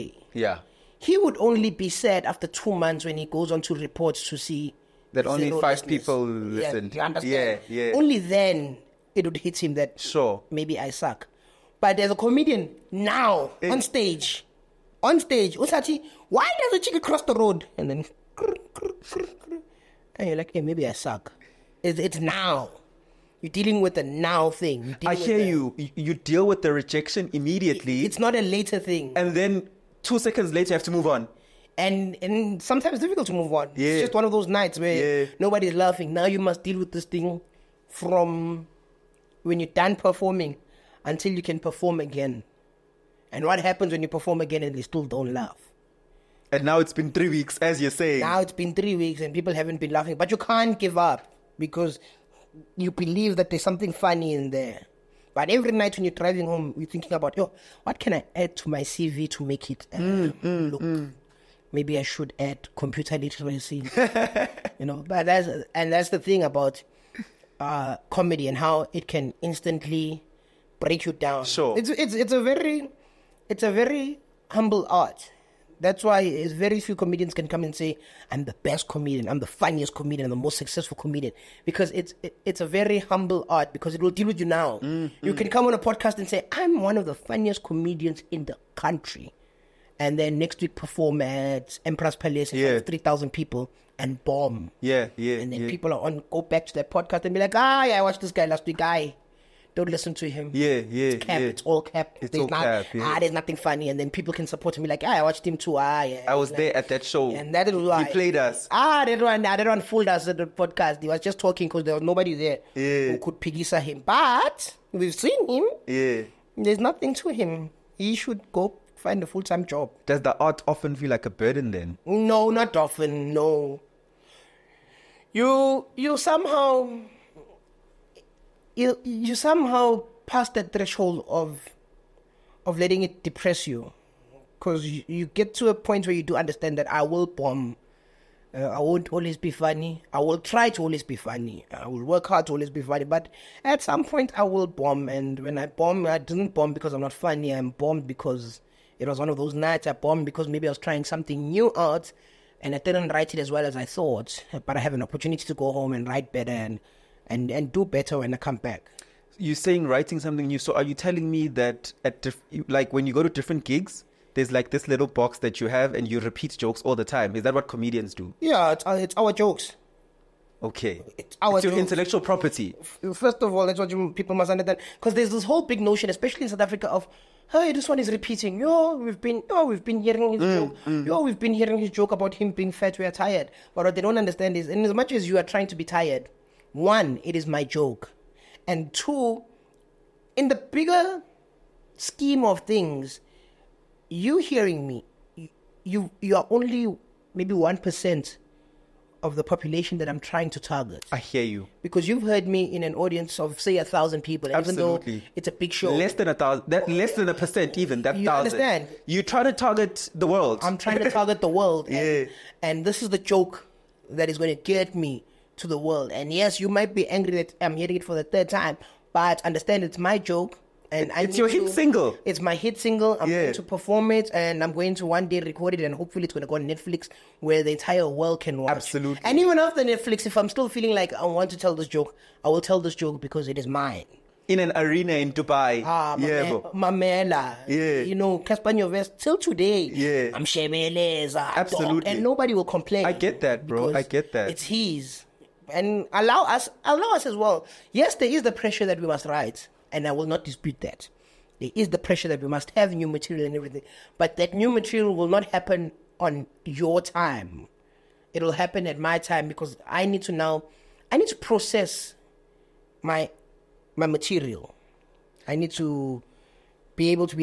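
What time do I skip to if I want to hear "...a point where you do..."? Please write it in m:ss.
2:15.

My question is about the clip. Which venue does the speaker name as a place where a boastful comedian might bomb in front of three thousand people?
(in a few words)
Emperors Palace.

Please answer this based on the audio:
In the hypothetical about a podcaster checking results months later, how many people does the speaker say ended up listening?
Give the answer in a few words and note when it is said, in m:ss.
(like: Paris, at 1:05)
5, at 0:05.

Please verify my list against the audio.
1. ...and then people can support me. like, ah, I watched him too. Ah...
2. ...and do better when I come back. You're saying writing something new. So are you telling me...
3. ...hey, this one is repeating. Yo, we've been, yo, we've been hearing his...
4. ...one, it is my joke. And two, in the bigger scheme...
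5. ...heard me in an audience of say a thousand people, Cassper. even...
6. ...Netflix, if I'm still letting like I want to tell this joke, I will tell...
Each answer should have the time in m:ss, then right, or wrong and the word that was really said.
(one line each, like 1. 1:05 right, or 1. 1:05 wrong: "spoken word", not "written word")
1. 1:43 right
2. 2:37 right
3. 2:57 right
4. 3:06 right
5. 3:22 wrong: "Absolutely", not "Cassper"
6. 3:49 wrong: "feeling", not "letting".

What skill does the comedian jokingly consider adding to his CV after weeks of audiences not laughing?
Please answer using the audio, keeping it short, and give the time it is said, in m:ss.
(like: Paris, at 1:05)
computer literacy, at 1:02.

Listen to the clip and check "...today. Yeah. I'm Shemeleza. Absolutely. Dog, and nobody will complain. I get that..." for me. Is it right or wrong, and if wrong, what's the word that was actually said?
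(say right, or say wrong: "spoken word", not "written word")
right.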